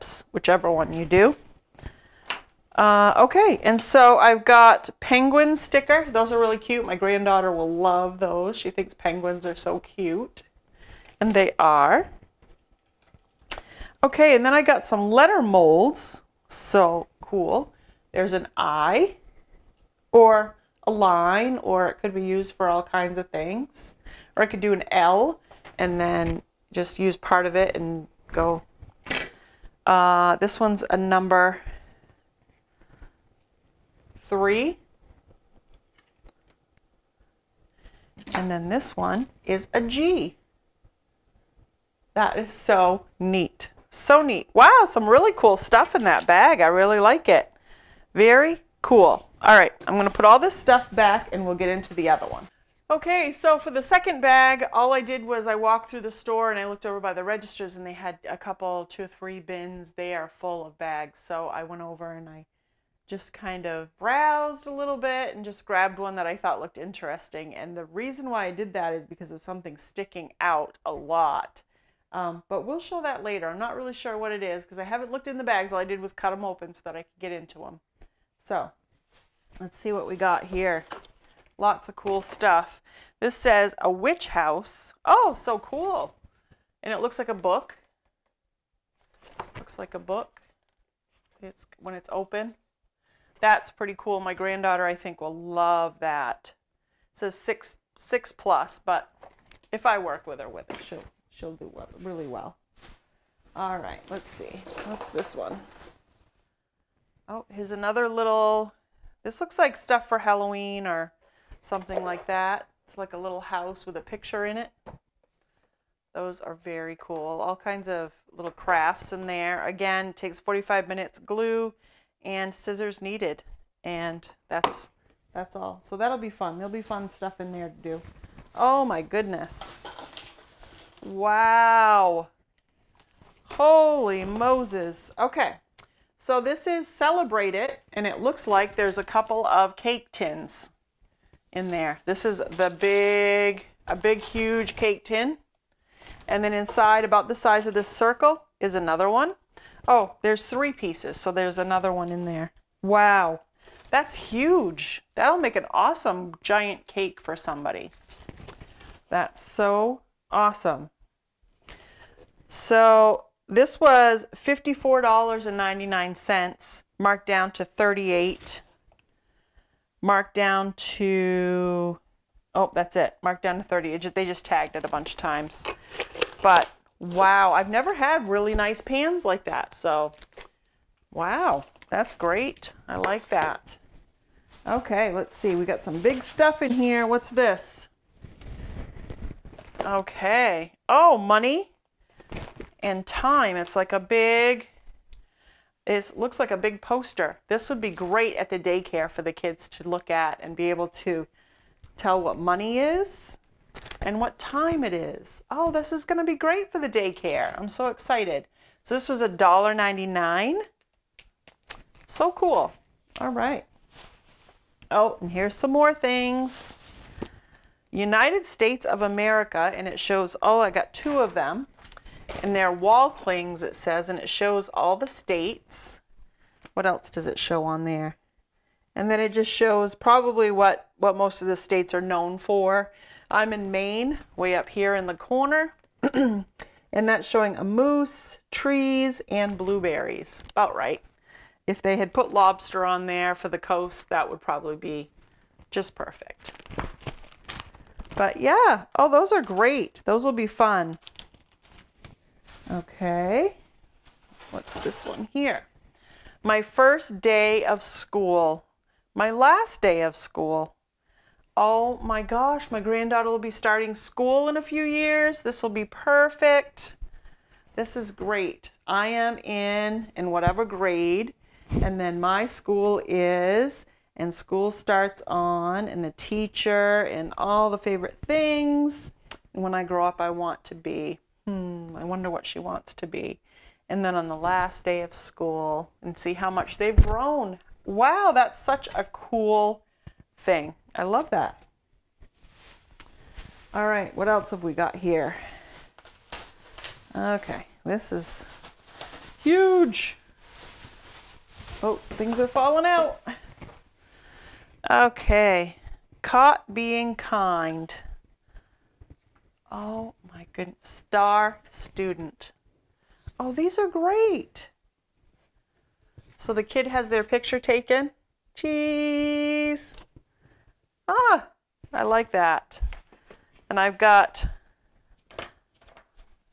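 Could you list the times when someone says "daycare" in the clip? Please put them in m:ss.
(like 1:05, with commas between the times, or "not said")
3:18, 3:26.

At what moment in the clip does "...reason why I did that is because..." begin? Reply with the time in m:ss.
1:07.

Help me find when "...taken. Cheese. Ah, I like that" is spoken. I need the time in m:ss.
5:17.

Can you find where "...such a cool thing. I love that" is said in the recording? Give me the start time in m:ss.
4:48.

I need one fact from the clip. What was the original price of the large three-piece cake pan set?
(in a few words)
$54.99.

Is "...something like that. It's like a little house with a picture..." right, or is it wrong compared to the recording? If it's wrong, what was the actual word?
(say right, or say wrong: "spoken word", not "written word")
right.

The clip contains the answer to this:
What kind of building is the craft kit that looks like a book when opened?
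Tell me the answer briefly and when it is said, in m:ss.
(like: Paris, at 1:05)
A witch house, at 1:23.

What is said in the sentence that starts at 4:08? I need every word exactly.
But yeah, oh, those are great.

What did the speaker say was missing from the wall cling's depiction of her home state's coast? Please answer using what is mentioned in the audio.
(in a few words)
Lobster.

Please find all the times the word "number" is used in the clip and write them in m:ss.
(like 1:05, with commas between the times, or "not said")
0:30.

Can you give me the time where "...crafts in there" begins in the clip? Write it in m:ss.
1:58.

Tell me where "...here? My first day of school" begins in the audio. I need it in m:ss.
4:15.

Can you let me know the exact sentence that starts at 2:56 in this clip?
But wow, I've never had really nice pans like that.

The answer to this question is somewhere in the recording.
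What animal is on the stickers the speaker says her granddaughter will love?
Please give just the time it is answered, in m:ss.
0:04.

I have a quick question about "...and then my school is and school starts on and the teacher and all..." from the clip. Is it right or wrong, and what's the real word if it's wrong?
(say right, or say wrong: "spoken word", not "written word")
right.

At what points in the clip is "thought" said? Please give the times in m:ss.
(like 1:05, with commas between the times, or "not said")
1:06.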